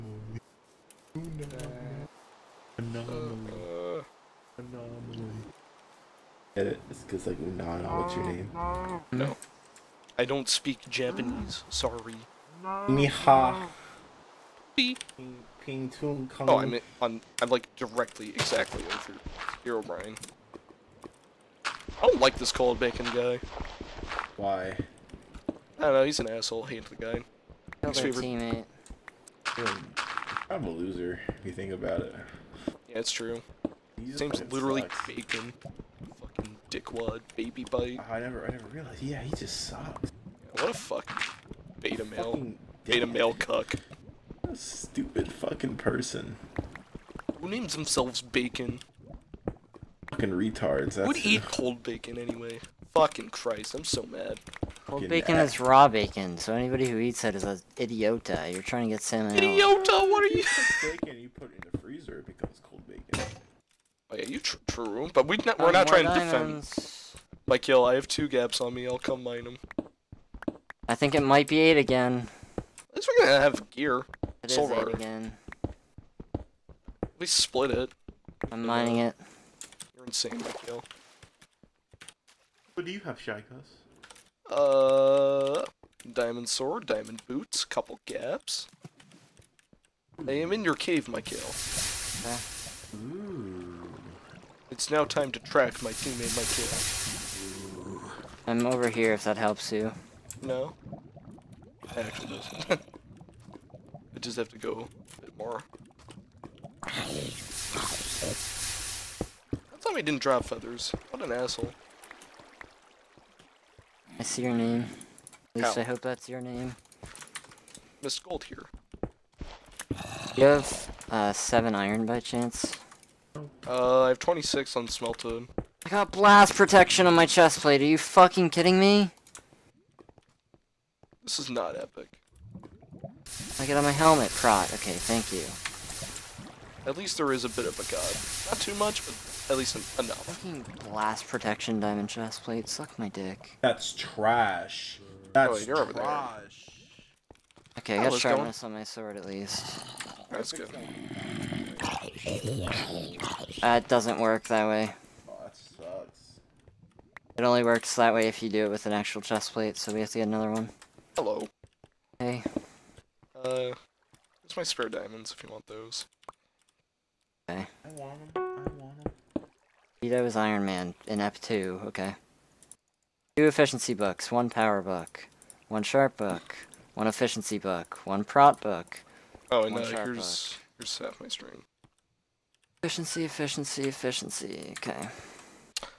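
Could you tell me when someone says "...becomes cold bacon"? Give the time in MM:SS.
01:02.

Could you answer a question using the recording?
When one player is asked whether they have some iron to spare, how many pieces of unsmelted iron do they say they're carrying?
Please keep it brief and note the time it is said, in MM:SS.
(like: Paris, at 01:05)
26, at 02:04.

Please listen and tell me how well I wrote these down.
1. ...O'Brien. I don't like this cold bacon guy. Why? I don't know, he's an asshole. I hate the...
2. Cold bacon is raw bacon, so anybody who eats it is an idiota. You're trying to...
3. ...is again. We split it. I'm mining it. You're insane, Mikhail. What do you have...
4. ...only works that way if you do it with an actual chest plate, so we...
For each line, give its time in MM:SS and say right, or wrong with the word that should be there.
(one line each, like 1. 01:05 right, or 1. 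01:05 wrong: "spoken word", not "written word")
1. 00:19 right
2. 00:54 right
3. 01:14 right
4. 02:37 right.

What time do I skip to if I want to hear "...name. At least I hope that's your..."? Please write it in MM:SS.
01:54.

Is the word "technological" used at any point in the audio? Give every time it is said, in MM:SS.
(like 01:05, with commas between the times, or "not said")
not said.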